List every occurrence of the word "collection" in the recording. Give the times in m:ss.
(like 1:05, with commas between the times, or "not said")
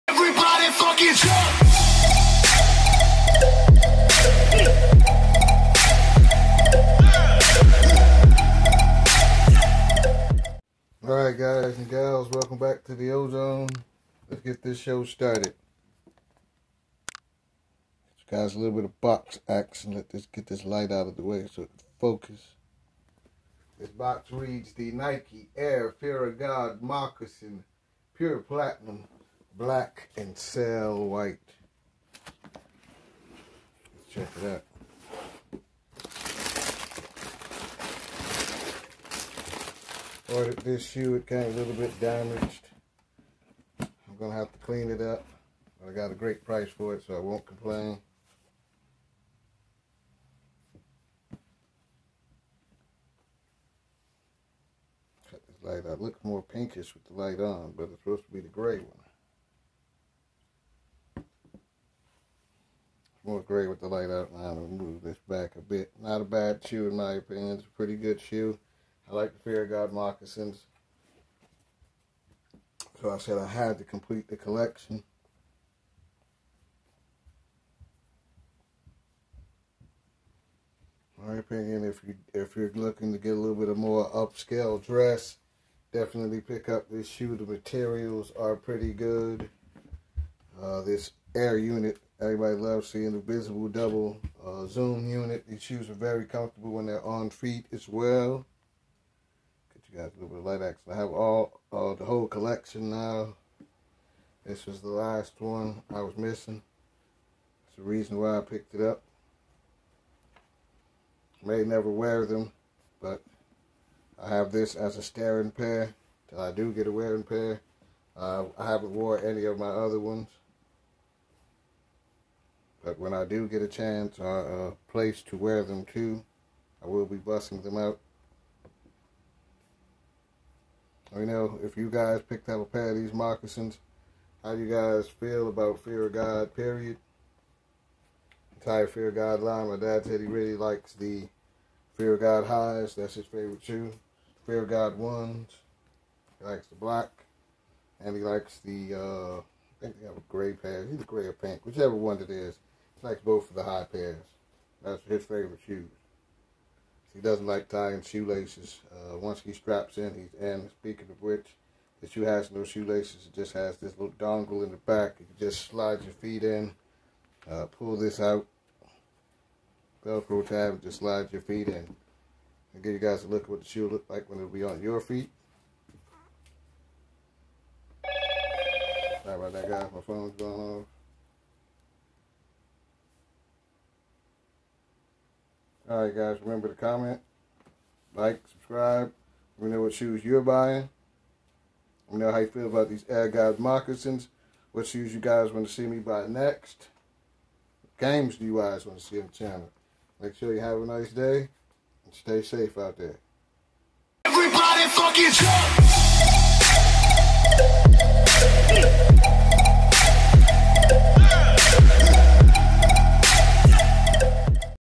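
1:14, 1:42.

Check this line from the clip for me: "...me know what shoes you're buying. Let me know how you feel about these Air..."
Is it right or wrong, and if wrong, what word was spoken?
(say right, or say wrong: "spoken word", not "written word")
right.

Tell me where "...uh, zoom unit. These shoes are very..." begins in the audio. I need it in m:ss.
1:34.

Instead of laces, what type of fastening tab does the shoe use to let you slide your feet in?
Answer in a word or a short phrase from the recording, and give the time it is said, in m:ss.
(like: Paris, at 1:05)
Velcro tab, at 2:50.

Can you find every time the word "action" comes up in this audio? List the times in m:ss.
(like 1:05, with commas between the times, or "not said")
0:19, 1:40.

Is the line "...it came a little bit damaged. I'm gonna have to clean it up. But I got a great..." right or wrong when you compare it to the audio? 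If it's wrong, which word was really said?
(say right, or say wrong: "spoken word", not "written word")
right.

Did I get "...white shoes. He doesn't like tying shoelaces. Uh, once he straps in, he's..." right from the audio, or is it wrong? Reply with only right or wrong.
wrong.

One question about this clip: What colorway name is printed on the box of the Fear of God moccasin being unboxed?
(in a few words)
Pure Platinum.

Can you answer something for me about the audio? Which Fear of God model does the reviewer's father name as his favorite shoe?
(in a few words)
Fear of God highs.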